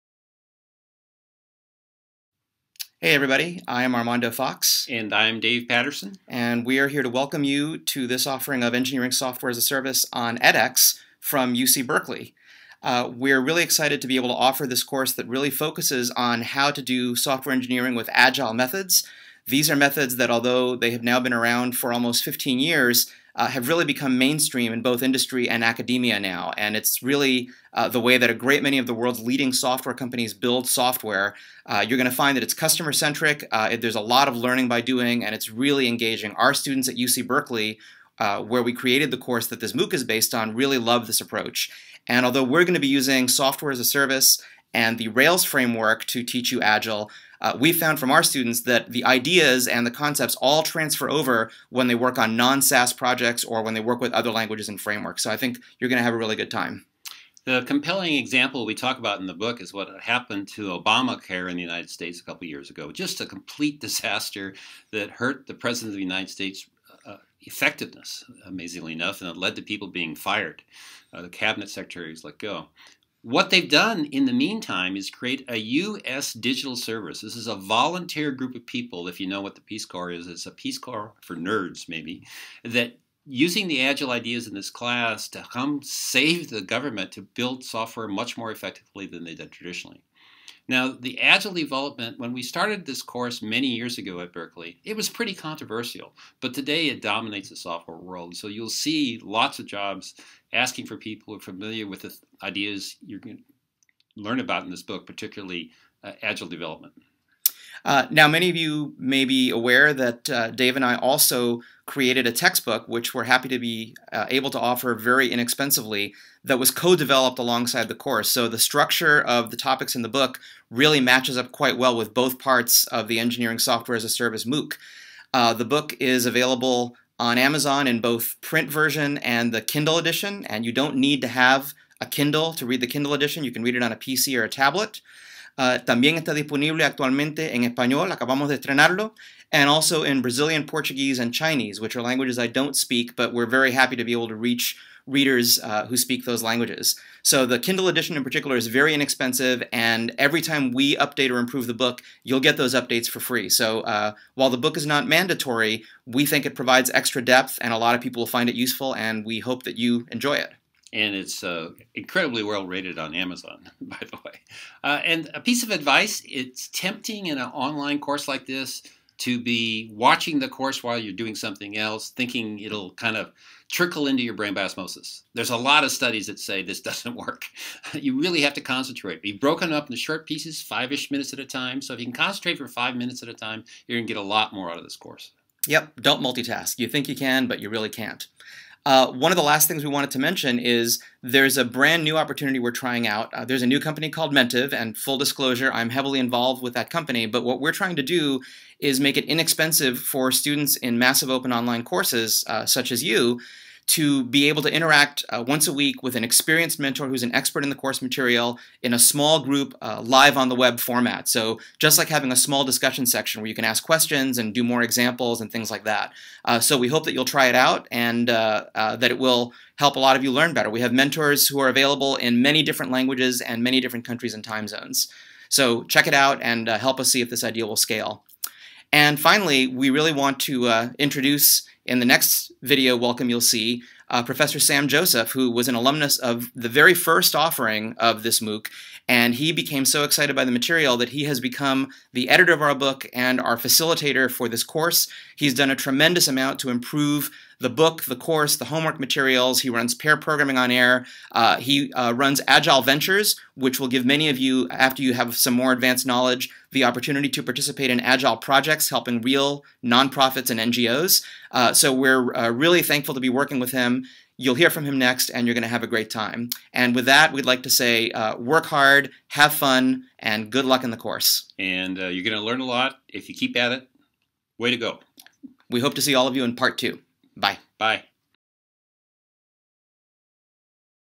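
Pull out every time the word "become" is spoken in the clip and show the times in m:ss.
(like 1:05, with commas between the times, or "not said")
0:23, 4:01.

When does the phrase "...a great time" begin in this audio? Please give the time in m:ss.
4:25.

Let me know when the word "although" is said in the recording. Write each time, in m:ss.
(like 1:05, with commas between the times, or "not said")
0:20, 0:42.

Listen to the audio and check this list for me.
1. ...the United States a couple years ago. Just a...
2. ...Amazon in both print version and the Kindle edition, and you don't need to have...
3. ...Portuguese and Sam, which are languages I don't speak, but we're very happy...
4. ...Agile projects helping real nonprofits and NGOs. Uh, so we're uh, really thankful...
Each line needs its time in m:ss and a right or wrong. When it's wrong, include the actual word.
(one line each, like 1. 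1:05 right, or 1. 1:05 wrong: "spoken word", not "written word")
1. 1:01 right
2. 2:07 right
3. 2:20 wrong: "Chinese", not "Sam"
4. 4:17 right.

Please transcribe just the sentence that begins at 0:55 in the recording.
So I think you're going to have a really good time.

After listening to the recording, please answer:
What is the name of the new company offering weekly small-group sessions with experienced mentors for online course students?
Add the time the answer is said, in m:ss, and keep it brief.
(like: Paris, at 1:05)
Mentiv, at 3:14.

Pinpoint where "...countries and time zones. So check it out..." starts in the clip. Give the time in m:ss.
3:44.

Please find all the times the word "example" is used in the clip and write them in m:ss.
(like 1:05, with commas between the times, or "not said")
0:58, 3:34.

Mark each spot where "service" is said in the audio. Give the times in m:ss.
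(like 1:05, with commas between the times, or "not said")
0:09, 0:43, 1:16, 2:04.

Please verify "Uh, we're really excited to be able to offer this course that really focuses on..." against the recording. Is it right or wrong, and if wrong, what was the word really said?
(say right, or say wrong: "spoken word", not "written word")
right.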